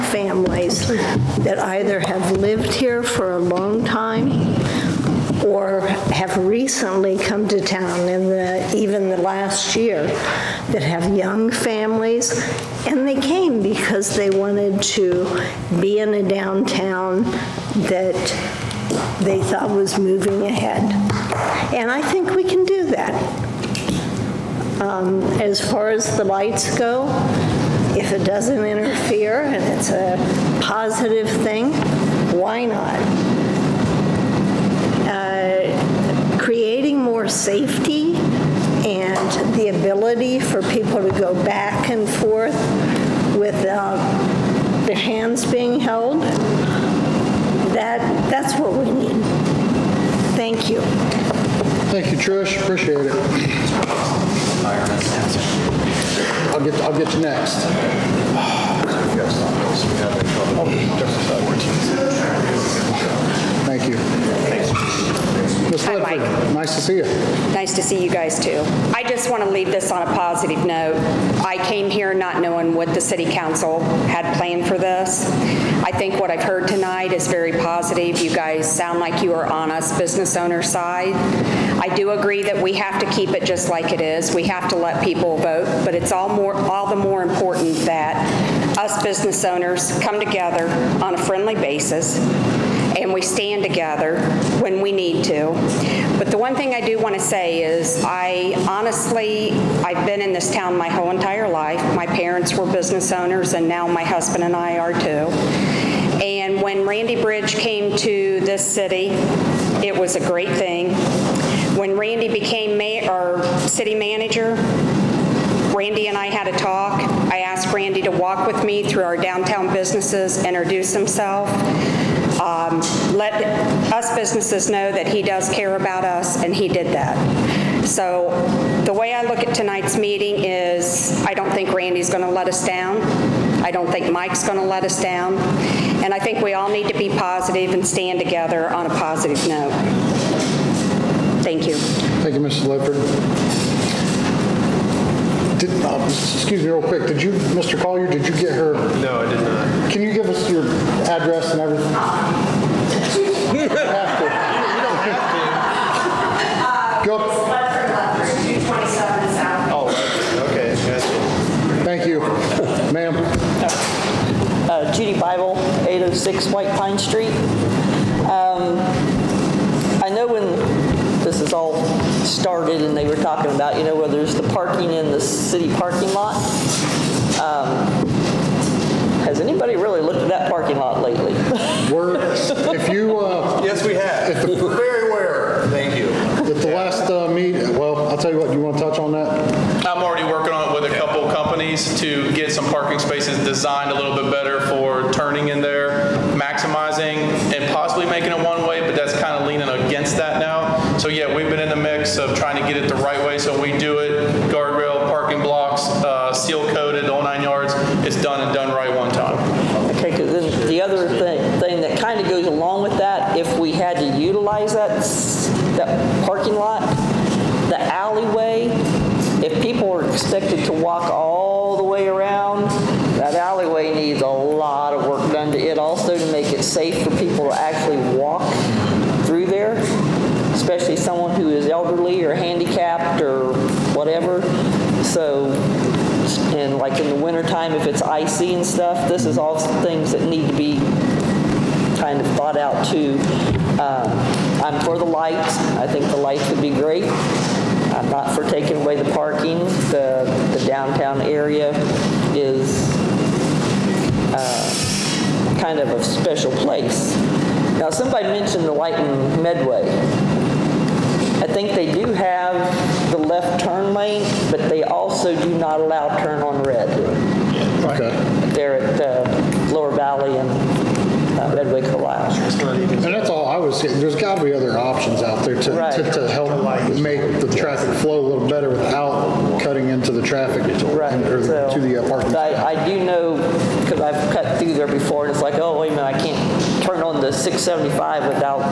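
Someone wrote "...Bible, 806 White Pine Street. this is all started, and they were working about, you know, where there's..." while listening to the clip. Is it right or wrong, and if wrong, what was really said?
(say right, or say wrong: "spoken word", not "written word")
wrong: "talking", not "working".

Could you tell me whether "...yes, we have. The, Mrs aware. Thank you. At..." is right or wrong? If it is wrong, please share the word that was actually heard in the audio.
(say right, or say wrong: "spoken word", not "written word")
wrong: "Very", not "Mrs".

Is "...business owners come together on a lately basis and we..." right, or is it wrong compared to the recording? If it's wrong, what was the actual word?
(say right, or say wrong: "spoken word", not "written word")
wrong: "friendly", not "lately".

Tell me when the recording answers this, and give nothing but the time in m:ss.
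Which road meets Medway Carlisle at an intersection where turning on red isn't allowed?
4:29.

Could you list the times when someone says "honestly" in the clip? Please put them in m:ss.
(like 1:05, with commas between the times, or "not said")
1:38.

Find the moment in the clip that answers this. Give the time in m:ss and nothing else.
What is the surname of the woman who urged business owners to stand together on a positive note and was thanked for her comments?
2:22.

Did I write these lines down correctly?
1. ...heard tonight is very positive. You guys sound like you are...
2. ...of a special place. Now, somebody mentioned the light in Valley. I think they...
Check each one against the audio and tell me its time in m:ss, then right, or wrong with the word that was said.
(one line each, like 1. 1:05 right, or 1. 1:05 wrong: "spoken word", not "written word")
1. 1:16 right
2. 4:15 wrong: "Medway", not "Valley".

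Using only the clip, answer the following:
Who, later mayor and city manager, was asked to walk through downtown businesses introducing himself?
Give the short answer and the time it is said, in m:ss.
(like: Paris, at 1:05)
Randy Bridge, at 1:46.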